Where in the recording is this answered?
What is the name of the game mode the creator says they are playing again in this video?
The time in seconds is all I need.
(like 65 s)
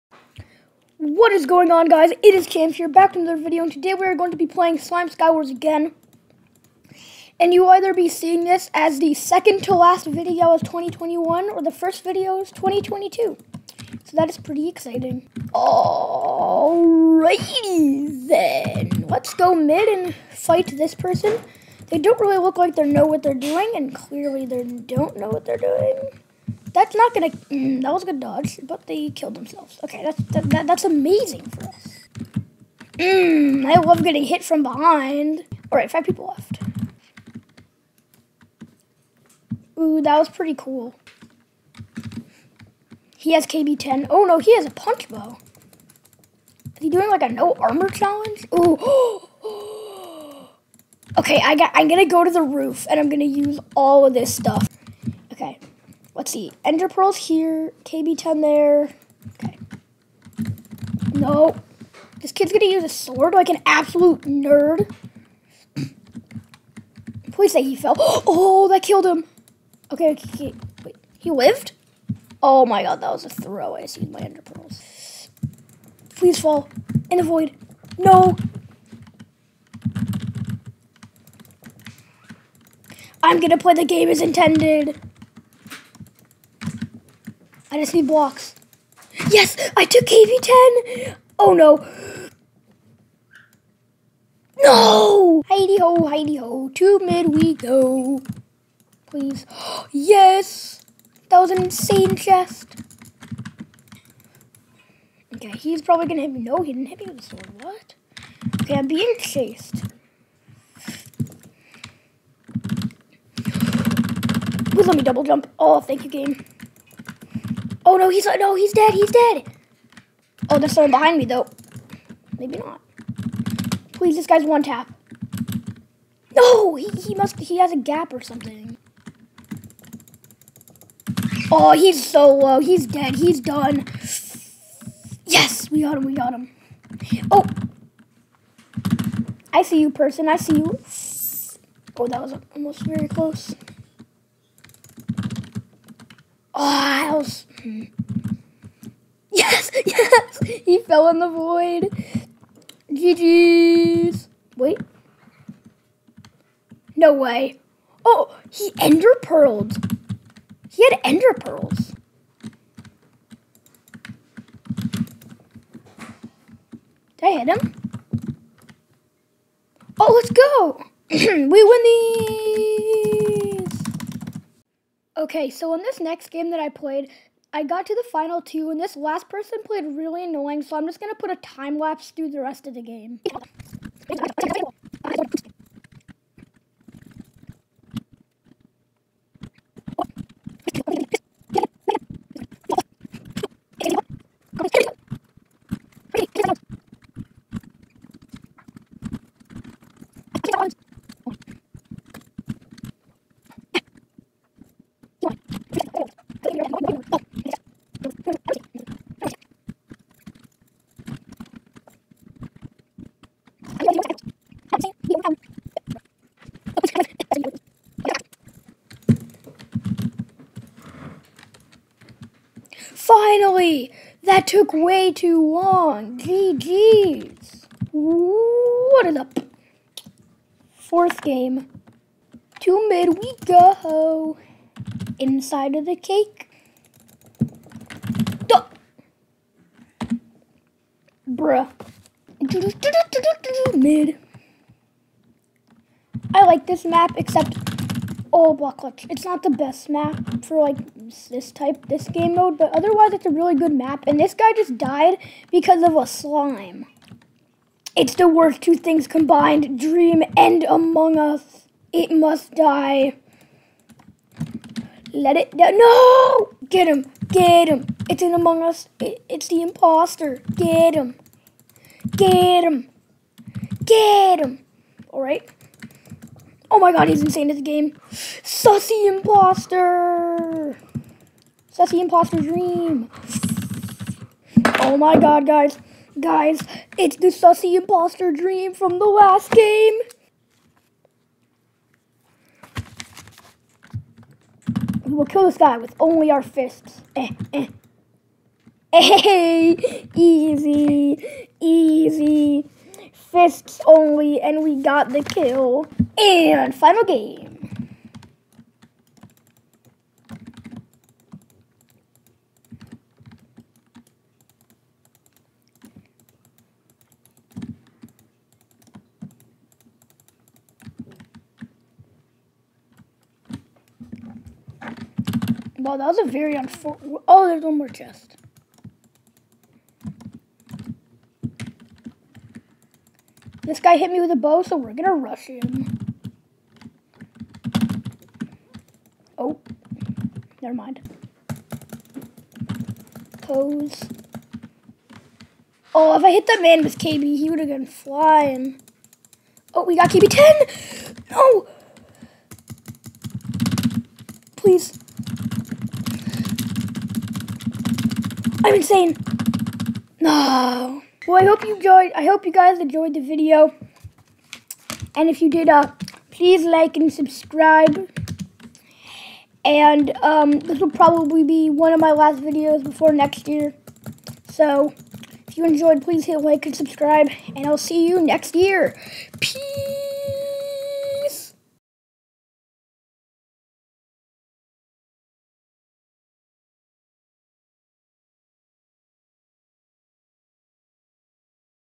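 4 s.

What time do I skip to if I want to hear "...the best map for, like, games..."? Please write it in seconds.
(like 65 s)
249 s.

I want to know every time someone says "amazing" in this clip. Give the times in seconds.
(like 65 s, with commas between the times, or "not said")
30 s.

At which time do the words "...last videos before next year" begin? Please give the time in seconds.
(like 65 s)
372 s.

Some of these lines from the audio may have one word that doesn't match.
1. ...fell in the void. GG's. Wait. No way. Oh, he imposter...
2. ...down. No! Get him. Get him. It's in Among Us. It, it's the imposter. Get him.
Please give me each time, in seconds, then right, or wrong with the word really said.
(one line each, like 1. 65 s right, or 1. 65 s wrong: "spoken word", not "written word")
1. 150 s wrong: "ender", not "imposter"
2. 265 s right.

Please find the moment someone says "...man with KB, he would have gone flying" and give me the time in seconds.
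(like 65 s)
346 s.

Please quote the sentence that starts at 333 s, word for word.
This guy hit me with a bow, so we're gonna rush him.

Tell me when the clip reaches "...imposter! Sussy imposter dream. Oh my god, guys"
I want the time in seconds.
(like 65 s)
279 s.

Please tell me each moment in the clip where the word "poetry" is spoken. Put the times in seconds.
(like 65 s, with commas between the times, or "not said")
not said.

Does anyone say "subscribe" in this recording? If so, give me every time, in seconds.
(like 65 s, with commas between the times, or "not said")
367 s, 376 s.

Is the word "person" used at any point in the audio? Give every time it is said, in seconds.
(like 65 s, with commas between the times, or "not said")
20 s, 139 s, 179 s.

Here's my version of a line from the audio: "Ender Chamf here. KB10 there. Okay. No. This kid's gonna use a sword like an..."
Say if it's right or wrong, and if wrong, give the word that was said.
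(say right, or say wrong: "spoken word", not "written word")
wrong: "Pearls", not "Chamf".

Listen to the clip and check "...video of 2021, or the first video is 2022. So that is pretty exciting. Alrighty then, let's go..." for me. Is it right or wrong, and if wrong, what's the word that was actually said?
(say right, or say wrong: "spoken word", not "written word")
right.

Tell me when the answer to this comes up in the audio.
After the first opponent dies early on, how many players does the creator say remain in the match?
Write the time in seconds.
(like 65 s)
35 s.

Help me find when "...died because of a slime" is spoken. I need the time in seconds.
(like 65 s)
254 s.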